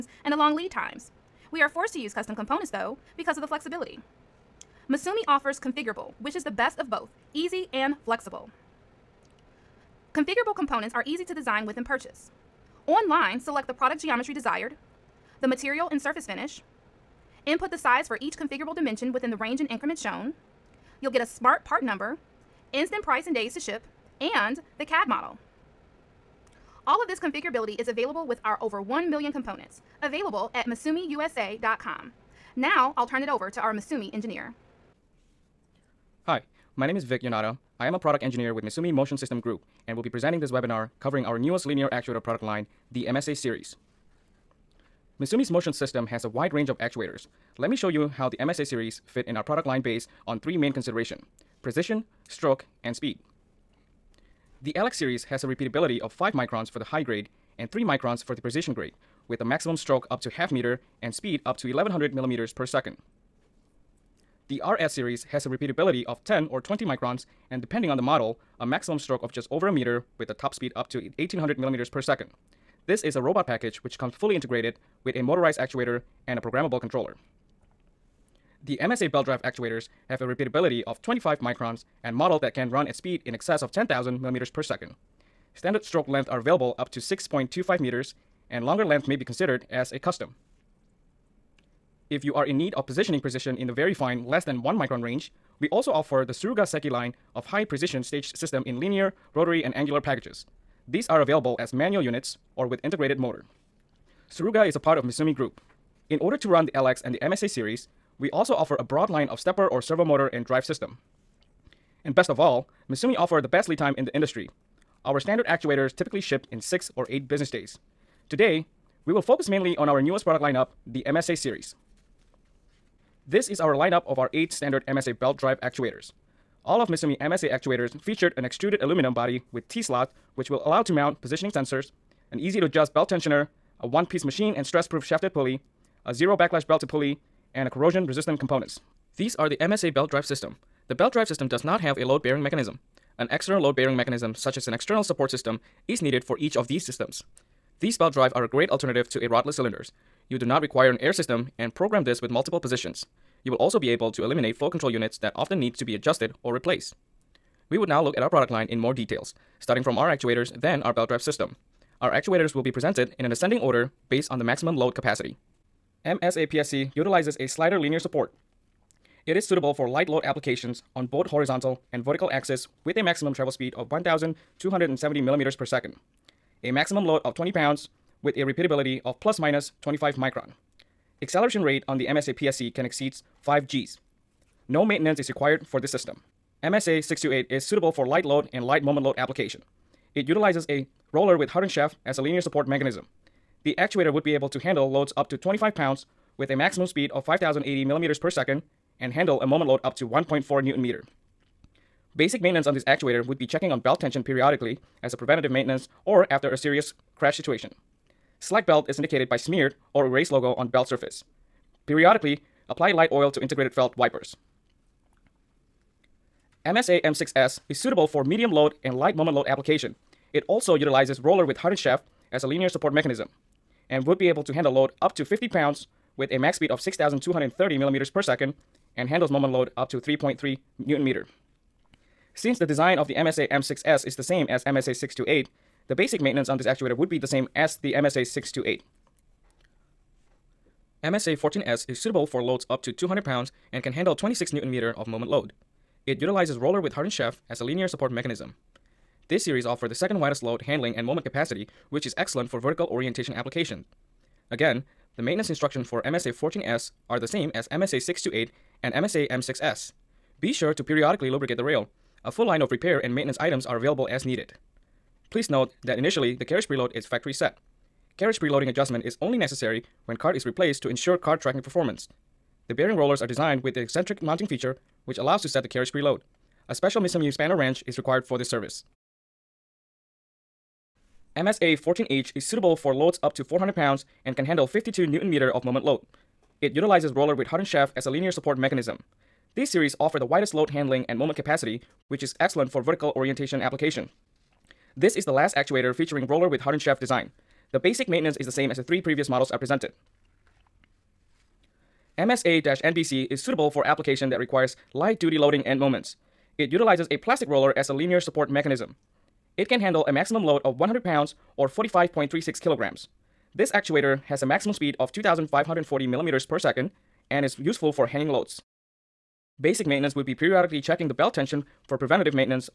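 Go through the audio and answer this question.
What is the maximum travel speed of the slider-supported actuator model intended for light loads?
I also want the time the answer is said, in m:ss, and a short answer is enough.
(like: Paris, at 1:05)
1,270 millimeters per second, at 2:53.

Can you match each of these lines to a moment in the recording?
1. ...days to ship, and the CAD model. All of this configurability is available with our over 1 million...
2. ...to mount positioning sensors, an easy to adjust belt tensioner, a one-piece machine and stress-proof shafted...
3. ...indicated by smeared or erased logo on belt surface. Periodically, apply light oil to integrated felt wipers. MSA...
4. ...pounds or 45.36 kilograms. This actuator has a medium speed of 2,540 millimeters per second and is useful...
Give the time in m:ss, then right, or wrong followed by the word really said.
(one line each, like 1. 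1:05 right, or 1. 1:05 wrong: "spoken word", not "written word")
1. 0:23 right
2. 2:10 right
3. 3:28 right
4. 5:11 wrong: "maximum", not "medium".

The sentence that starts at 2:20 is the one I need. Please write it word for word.
The belt drive system does not have a load-bearing mechanism.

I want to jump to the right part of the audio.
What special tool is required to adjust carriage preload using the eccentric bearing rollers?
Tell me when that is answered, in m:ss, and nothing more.
4:37.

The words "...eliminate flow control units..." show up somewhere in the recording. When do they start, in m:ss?
2:34.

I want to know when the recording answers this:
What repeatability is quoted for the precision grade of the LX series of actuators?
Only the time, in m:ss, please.
0:57.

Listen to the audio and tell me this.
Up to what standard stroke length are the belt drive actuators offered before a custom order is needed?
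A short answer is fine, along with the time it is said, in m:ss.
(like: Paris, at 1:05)
6.25 meters, at 1:26.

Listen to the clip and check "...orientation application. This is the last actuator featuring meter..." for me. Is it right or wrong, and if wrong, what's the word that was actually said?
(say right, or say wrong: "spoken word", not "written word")
wrong: "roller", not "meter".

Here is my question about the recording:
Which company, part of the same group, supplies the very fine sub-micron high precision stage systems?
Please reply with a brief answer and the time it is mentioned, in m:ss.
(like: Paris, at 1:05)
Suruga Seiki, at 1:36.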